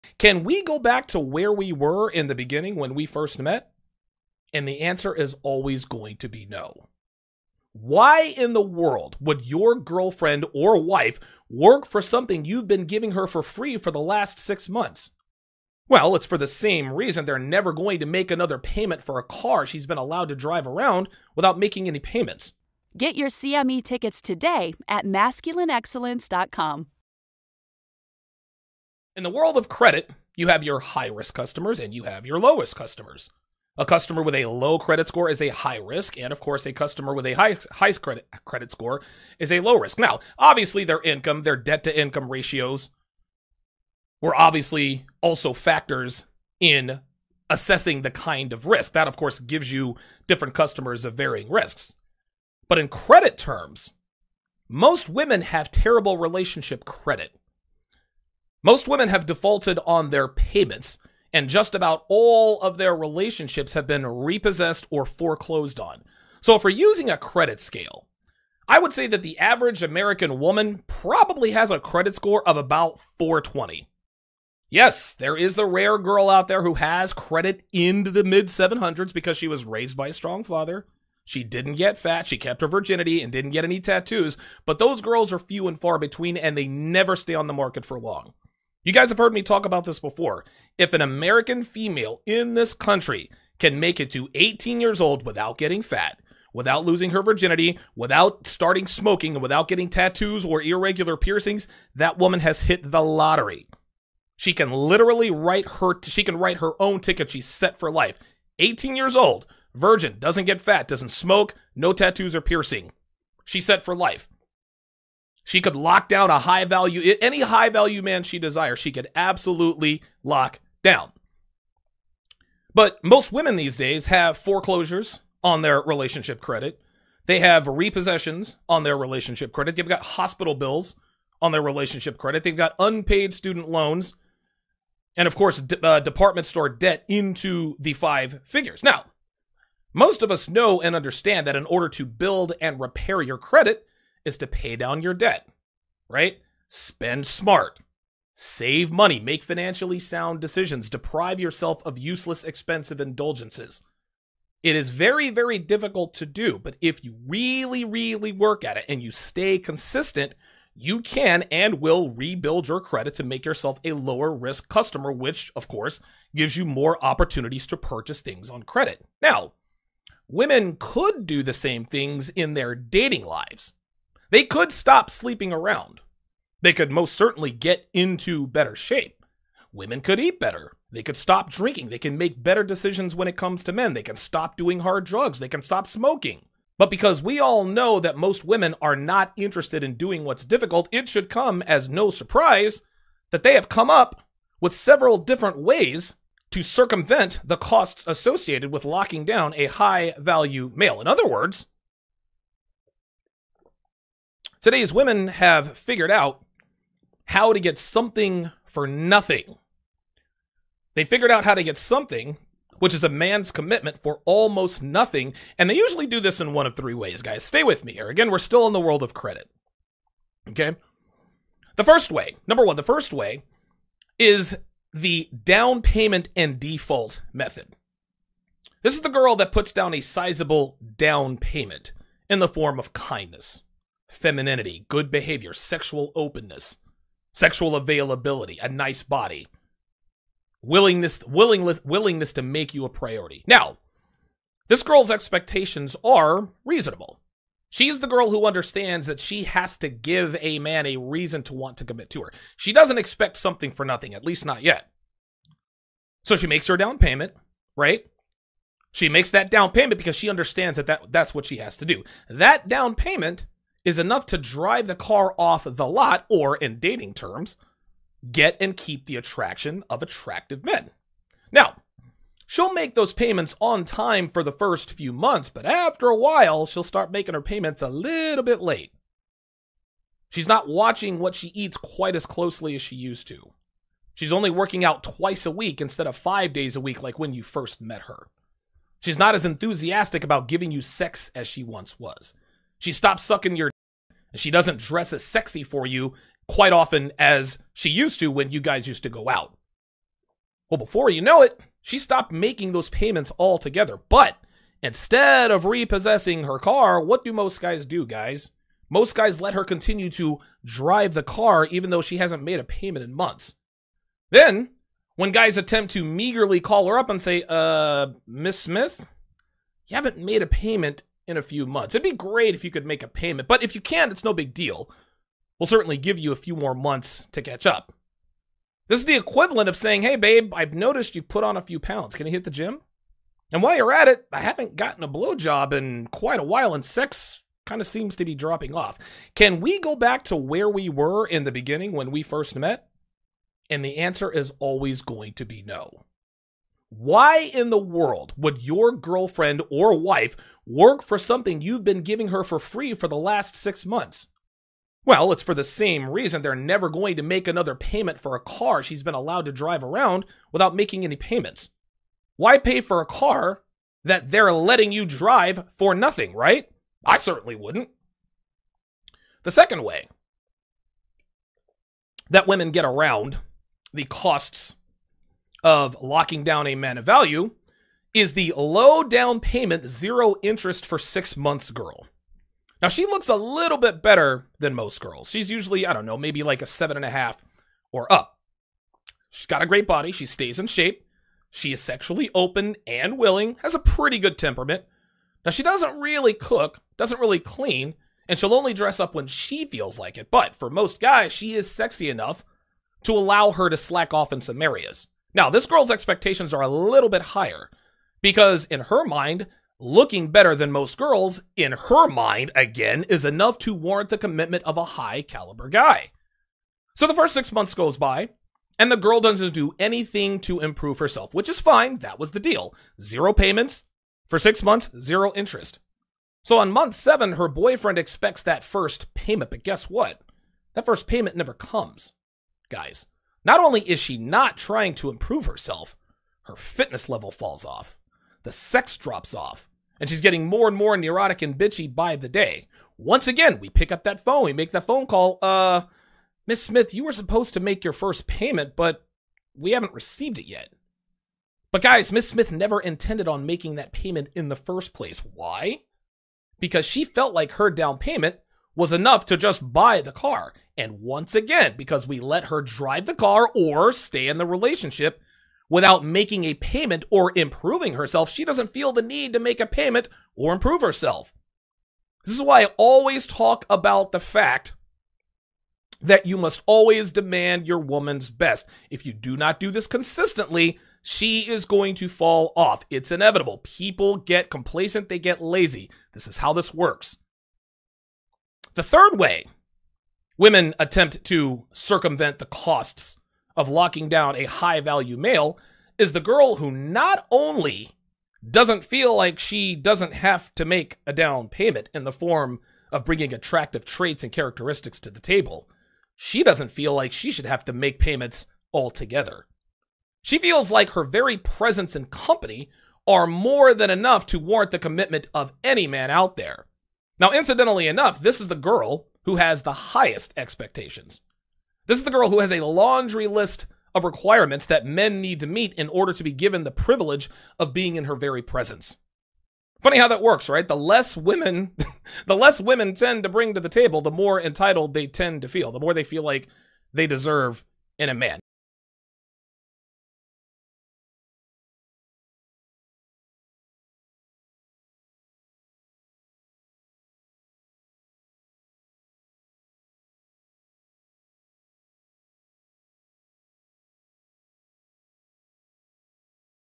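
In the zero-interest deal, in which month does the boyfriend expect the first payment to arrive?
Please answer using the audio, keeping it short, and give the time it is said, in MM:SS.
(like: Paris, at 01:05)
month 7, at 07:06.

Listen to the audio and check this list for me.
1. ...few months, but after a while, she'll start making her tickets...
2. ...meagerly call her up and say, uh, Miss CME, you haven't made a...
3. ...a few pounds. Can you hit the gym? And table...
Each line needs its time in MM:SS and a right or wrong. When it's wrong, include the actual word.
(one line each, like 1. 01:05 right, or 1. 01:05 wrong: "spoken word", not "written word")
1. 04:34 wrong: "payments", not "tickets"
2. 05:16 wrong: "Smith", not "CME"
3. 05:31 wrong: "while", not "table".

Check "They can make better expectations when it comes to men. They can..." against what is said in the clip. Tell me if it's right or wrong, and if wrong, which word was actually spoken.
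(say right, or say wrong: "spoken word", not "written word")
wrong: "decisions", not "expectations".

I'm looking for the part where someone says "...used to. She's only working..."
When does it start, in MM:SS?
04:42.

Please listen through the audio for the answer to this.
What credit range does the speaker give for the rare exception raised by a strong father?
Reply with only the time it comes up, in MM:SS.
01:18.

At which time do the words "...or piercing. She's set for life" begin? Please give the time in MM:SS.
01:52.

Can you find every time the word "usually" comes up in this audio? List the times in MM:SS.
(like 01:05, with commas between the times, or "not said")
03:35, 06:25.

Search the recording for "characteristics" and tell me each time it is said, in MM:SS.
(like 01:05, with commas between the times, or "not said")
08:24.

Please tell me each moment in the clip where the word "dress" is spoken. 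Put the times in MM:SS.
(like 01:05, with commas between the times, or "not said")
04:54, 06:38.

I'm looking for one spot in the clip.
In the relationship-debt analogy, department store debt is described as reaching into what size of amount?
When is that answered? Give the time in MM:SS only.
02:17.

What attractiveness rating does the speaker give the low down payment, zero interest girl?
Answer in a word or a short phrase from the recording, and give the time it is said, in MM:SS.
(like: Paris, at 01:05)
7.5, at 06:26.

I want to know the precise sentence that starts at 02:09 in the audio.
They've got hospital bills on their relationship credit.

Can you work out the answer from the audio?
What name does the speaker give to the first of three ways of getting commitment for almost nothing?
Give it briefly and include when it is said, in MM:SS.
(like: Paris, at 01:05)
down payment and default, at 03:45.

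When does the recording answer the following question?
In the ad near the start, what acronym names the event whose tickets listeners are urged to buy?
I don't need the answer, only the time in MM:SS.
00:23.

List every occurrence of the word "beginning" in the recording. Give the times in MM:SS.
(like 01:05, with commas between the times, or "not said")
00:02, 05:41.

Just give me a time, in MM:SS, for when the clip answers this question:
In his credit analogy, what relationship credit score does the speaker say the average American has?
01:13.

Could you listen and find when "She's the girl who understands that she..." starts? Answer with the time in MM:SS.
04:07.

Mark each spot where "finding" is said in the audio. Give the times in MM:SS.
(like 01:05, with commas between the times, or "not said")
not said.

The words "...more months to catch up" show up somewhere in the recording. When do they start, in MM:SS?
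05:26.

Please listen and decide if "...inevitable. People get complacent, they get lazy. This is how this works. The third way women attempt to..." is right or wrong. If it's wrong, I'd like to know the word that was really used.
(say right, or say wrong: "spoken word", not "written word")
right.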